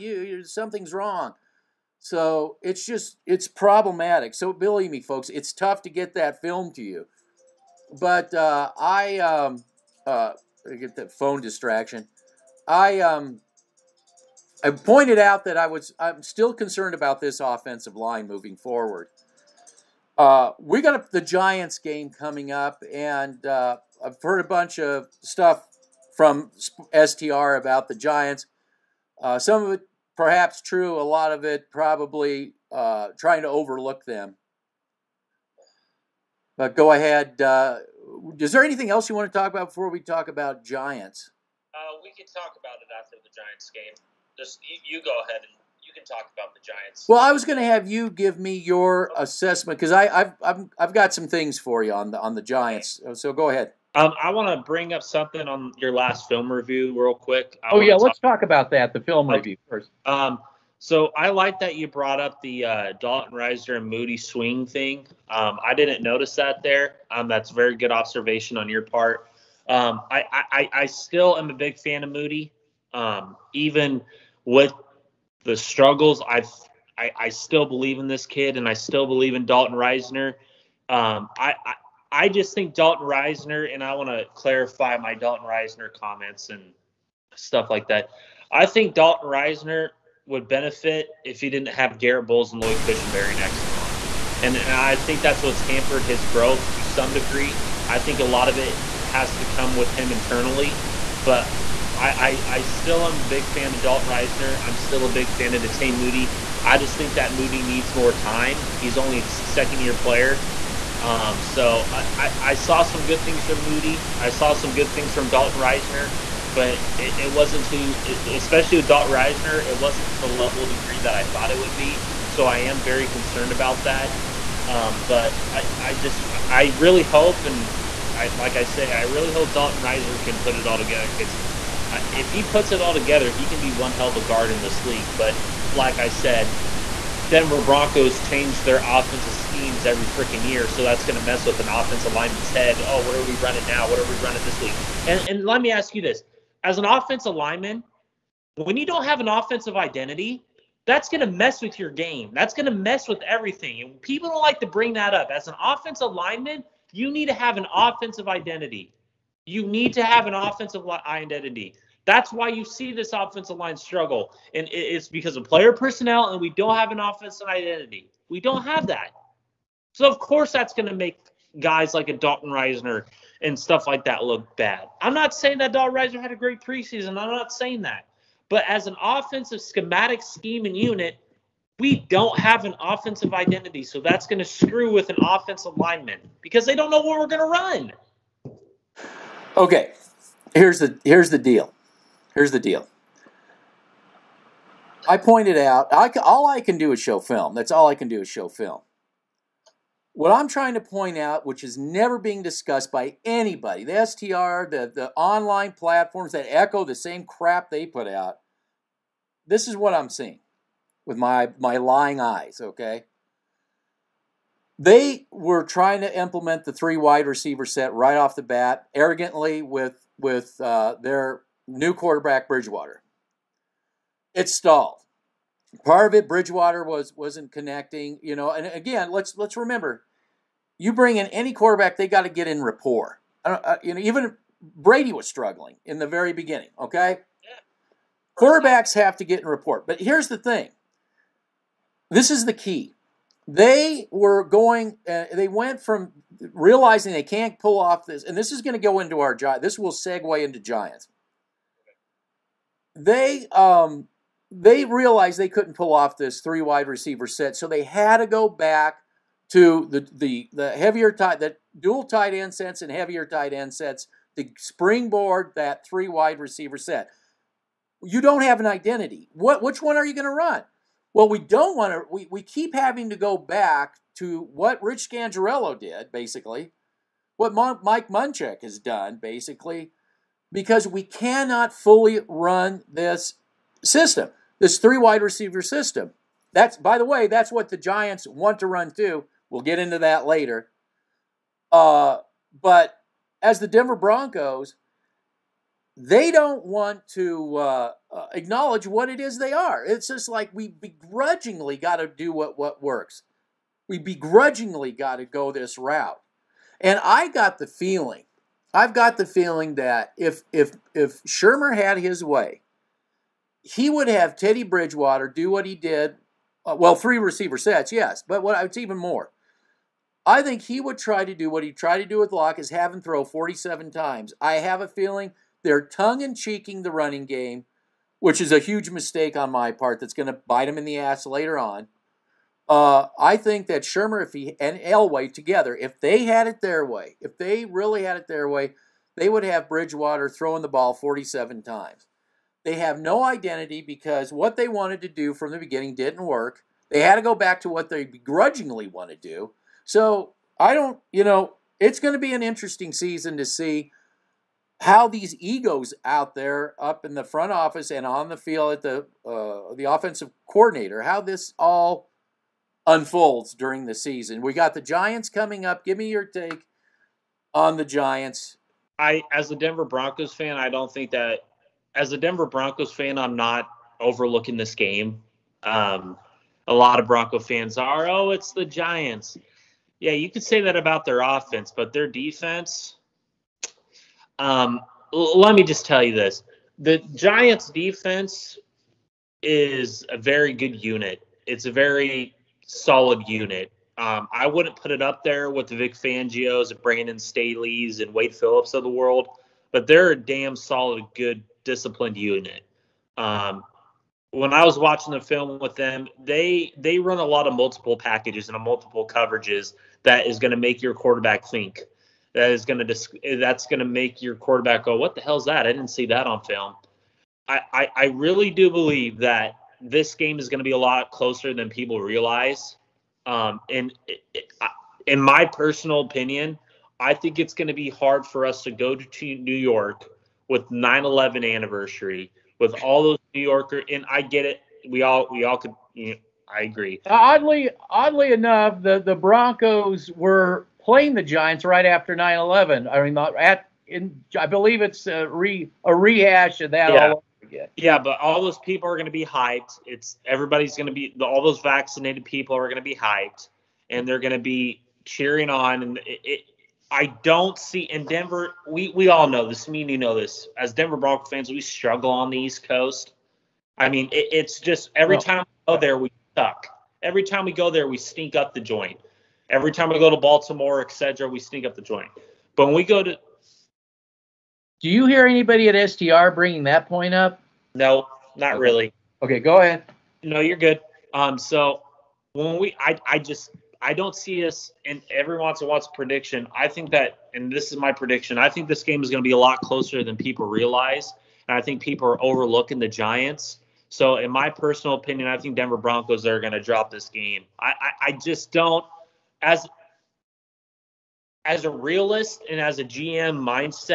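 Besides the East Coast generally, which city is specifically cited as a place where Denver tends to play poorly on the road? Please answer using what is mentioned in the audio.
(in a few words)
Baltimore.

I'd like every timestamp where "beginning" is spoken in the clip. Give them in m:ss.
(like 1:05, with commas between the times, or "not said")
3:56, 5:45.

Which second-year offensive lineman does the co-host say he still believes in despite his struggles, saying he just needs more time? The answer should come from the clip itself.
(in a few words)
Netane Muti.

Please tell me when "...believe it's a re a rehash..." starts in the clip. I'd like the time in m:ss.
7:24.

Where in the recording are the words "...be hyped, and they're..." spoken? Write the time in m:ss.
7:32.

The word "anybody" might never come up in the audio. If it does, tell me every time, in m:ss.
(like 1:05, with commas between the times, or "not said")
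3:23, 7:55.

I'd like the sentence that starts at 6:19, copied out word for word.
Yeah, you could say that about their offense, but their defense.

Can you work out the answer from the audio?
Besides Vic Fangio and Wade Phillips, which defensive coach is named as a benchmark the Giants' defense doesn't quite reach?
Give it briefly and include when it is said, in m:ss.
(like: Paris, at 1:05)
Brandon Staley, at 6:36.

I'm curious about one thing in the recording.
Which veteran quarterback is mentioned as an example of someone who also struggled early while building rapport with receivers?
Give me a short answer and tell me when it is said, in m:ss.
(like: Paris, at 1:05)
Brady, at 3:54.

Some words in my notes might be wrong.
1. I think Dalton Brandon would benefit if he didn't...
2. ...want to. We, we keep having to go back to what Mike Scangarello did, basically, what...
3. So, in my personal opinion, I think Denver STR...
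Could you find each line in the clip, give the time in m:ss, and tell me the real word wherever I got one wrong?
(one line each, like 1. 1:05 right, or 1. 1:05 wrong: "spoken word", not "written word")
1. 1:28 wrong: "Risner", not "Brandon"
2. 4:31 wrong: "Rich", not "Mike"
3. 8:13 wrong: "Broncos", not "STR".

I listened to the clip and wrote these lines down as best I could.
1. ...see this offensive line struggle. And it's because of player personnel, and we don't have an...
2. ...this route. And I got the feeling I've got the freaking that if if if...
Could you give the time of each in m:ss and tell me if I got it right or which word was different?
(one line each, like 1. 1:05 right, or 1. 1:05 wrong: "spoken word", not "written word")
1. 2:42 right
2. 5:05 wrong: "feeling", not "freaking".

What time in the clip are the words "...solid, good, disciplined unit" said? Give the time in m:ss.
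6:40.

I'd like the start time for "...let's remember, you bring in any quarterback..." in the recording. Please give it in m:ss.
3:49.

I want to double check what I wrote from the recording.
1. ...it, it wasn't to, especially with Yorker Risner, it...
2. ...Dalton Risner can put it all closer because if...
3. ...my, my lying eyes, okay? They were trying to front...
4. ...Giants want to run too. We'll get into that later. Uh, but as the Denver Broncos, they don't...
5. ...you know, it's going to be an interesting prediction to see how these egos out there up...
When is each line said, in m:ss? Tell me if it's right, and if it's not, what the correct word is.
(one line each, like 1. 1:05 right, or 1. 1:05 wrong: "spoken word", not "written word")
1. 1:56 wrong: "Dalton", not "Yorker"
2. 2:09 wrong: "together", not "closer"
3. 3:31 wrong: "implement", not "front"
4. 4:47 right
5. 5:51 wrong: "season", not "prediction".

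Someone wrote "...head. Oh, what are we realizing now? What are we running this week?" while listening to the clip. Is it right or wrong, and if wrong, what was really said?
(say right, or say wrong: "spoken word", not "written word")
wrong: "running", not "realizing".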